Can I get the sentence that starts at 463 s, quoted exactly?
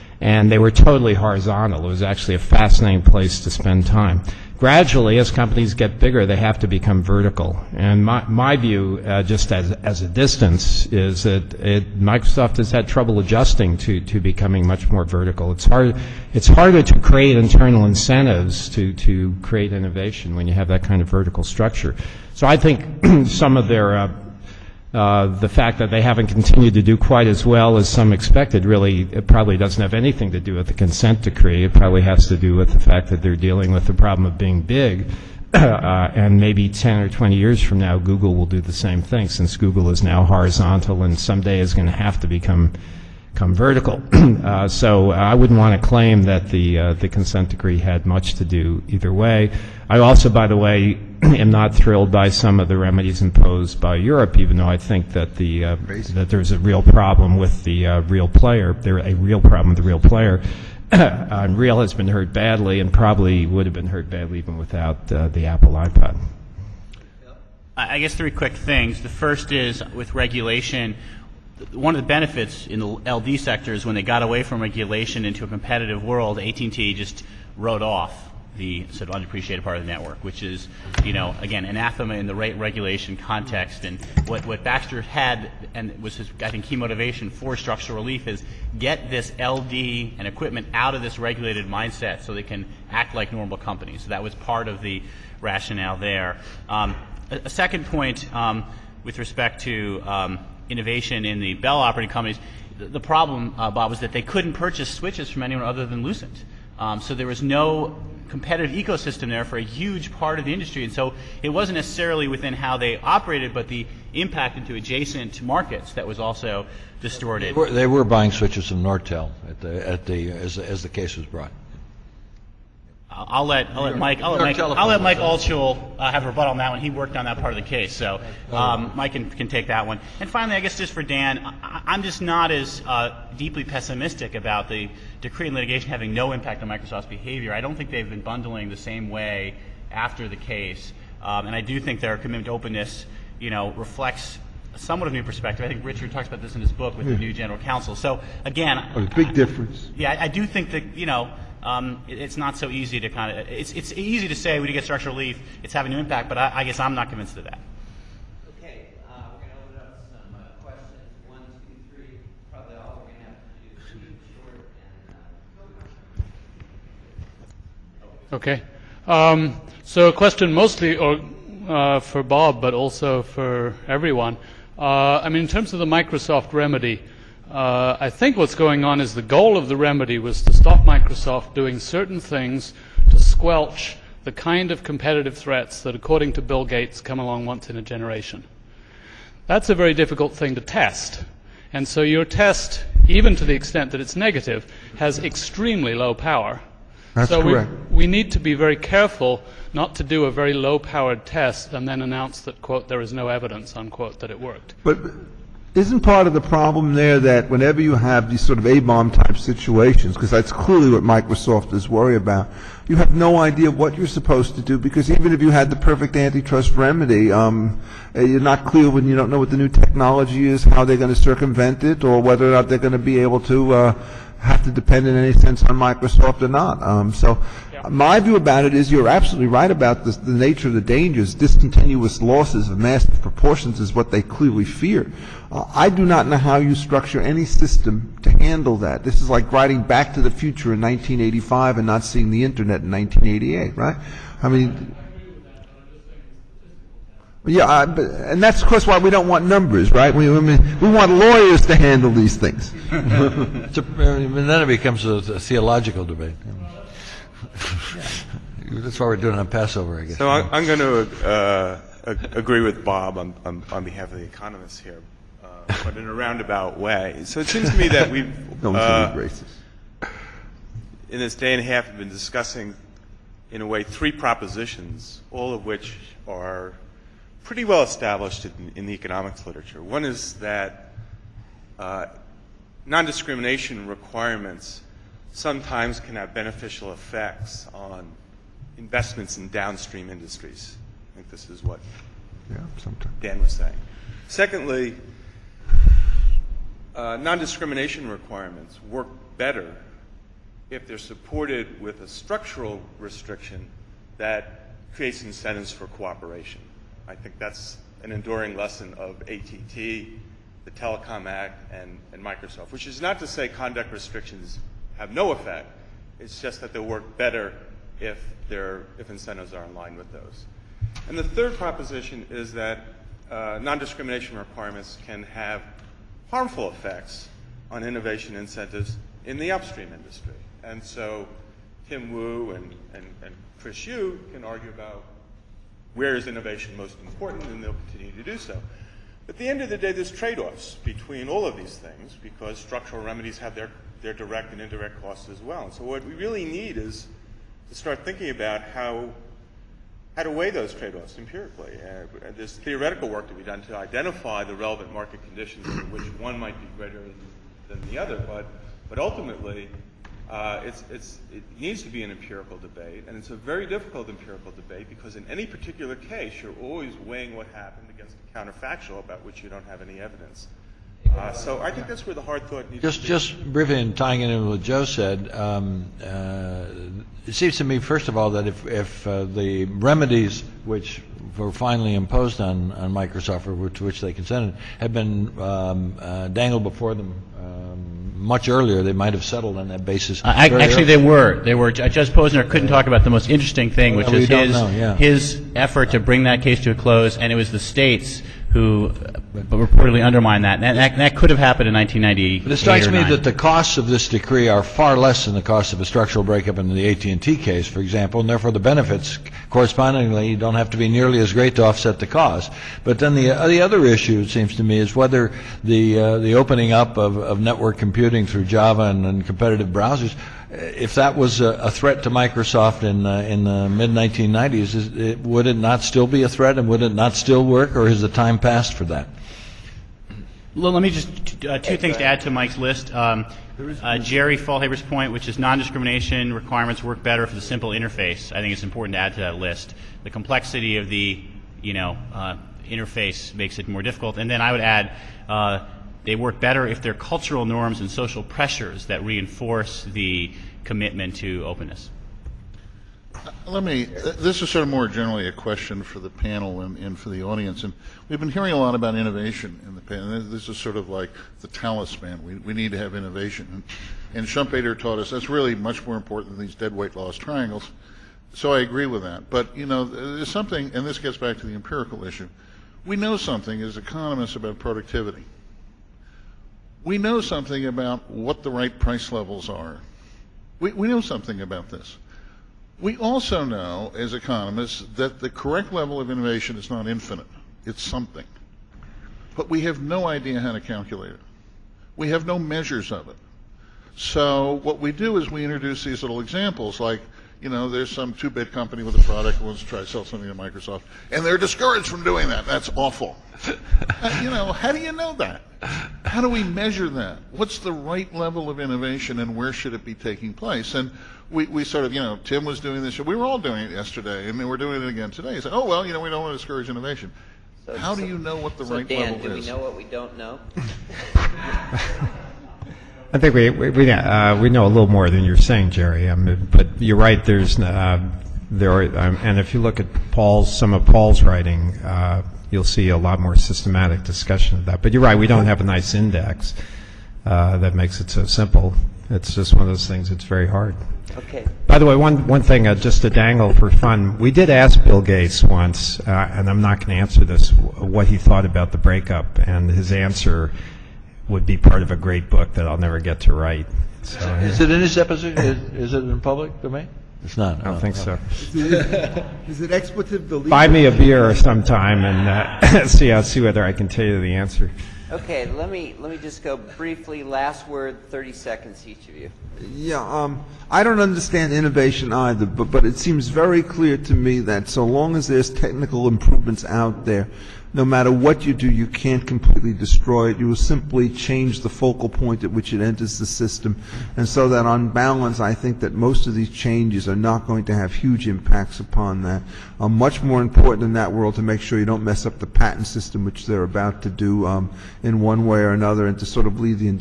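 And, and Schumpeter taught us that's really much more important than these deadweight loss triangles.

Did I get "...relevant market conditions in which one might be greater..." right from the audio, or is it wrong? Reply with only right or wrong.
right.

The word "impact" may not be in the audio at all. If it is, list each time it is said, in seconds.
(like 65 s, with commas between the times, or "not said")
114 s, 136 s, 155 s, 588 s.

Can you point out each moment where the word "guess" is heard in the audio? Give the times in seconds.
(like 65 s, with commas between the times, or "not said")
68 s, 130 s, 156 s, 260 s.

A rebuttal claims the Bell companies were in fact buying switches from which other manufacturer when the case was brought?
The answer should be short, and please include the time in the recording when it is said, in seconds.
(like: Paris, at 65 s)
Nortel, at 118 s.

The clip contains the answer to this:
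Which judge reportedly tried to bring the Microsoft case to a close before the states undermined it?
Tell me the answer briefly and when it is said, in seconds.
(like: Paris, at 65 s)
Judge Posner, at 391 s.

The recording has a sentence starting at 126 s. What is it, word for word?
He worked on that part of the case, so um, Mike can, can take that one.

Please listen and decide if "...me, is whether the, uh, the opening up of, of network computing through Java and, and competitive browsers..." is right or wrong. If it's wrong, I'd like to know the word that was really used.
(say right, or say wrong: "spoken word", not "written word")
right.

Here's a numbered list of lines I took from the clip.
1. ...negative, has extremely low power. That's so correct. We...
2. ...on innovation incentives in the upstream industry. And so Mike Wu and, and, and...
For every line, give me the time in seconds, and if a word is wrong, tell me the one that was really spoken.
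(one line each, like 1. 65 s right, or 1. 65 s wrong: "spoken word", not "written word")
1. 194 s right
2. 327 s wrong: "Tim", not "Mike".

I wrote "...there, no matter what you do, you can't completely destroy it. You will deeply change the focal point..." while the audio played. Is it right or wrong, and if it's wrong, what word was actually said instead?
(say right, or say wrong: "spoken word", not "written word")
wrong: "simply", not "deeply".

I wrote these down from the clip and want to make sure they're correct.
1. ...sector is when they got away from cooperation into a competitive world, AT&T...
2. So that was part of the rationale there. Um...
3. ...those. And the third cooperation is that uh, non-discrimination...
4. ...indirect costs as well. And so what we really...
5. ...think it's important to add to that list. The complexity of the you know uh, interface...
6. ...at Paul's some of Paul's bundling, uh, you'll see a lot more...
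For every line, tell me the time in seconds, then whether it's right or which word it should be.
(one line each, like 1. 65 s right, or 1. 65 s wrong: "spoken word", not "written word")
1. 73 s wrong: "regulation", not "cooperation"
2. 94 s right
3. 320 s wrong: "proposition", not "cooperation"
4. 344 s right
5. 438 s right
6. 529 s wrong: "writing", not "bundling".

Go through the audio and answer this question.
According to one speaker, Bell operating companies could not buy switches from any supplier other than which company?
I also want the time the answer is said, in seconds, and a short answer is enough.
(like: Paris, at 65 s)
Lucent, at 106 s.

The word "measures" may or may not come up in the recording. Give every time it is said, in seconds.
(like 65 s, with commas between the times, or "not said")
492 s, 506 s.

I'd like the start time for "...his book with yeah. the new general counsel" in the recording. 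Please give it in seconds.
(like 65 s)
146 s.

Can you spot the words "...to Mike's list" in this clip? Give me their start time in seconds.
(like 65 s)
432 s.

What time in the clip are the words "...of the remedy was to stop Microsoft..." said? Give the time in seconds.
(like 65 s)
179 s.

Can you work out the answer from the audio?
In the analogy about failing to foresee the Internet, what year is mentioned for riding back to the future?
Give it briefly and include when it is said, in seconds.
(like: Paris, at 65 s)
1985, at 240 s.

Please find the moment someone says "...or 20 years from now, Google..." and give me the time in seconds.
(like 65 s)
37 s.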